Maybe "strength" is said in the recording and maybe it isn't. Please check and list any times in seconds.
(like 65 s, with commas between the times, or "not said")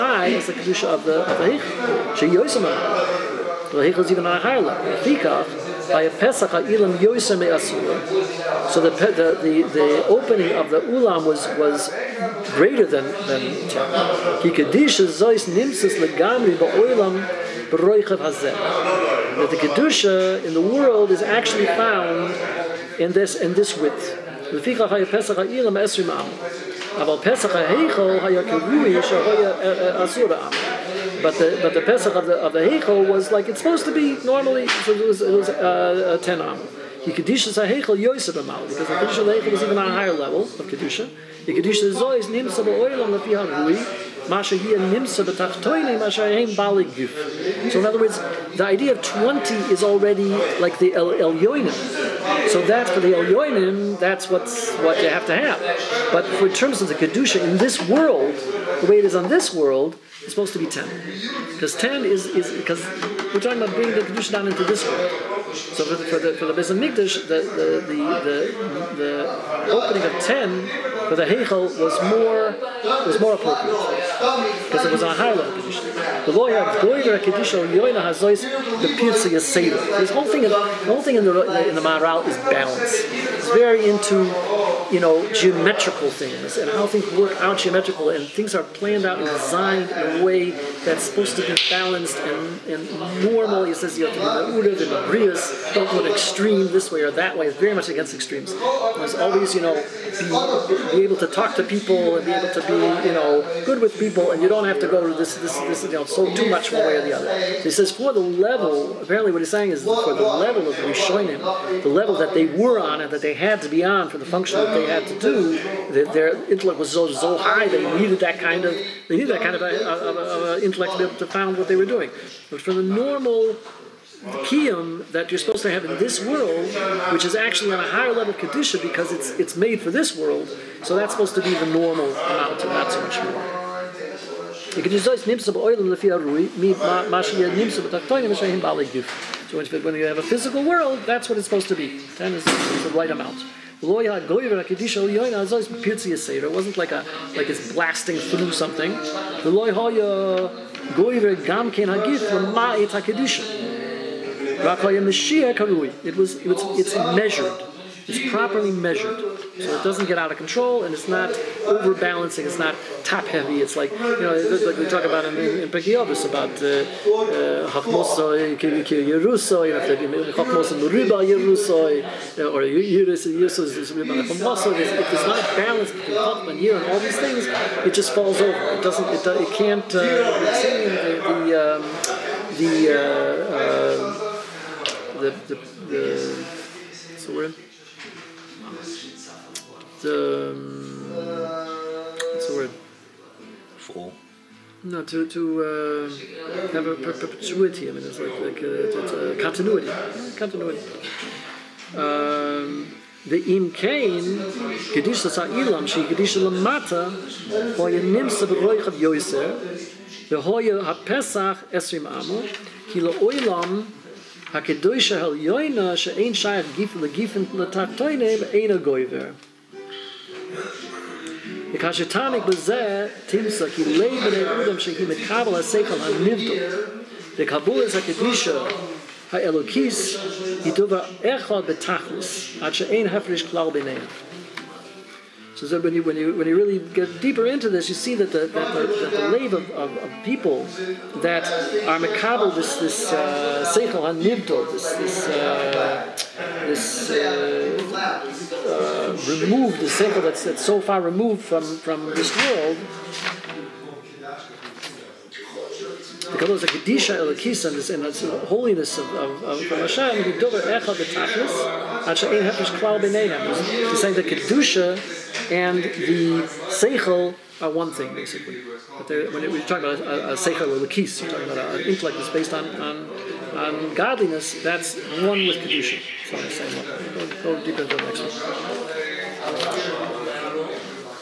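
not said.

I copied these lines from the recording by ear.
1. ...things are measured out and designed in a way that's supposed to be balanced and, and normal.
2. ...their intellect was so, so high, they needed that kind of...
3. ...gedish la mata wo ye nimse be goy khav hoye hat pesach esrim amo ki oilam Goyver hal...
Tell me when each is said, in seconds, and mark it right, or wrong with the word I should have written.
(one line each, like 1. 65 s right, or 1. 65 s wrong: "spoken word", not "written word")
1. 88 s wrong: "planned", not "measured"
2. 116 s right
3. 206 s wrong: "Hakedoyshe", not "Goyver".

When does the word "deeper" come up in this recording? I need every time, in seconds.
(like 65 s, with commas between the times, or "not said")
237 s, 277 s.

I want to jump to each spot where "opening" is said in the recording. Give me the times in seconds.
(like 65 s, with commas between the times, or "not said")
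10 s, 69 s.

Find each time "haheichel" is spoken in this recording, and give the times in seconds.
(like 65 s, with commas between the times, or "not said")
37 s.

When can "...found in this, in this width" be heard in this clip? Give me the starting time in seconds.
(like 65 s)
21 s.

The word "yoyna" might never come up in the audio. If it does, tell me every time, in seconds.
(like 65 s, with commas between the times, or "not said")
77 s, 215 s.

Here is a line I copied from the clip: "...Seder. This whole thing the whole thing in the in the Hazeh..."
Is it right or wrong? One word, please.
wrong.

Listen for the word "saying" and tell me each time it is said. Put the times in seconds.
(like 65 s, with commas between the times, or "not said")
109 s, 264 s, 276 s.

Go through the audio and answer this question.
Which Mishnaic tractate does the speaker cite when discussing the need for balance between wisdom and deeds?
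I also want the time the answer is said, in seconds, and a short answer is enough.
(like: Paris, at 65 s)
Pirkei Avos, at 165 s.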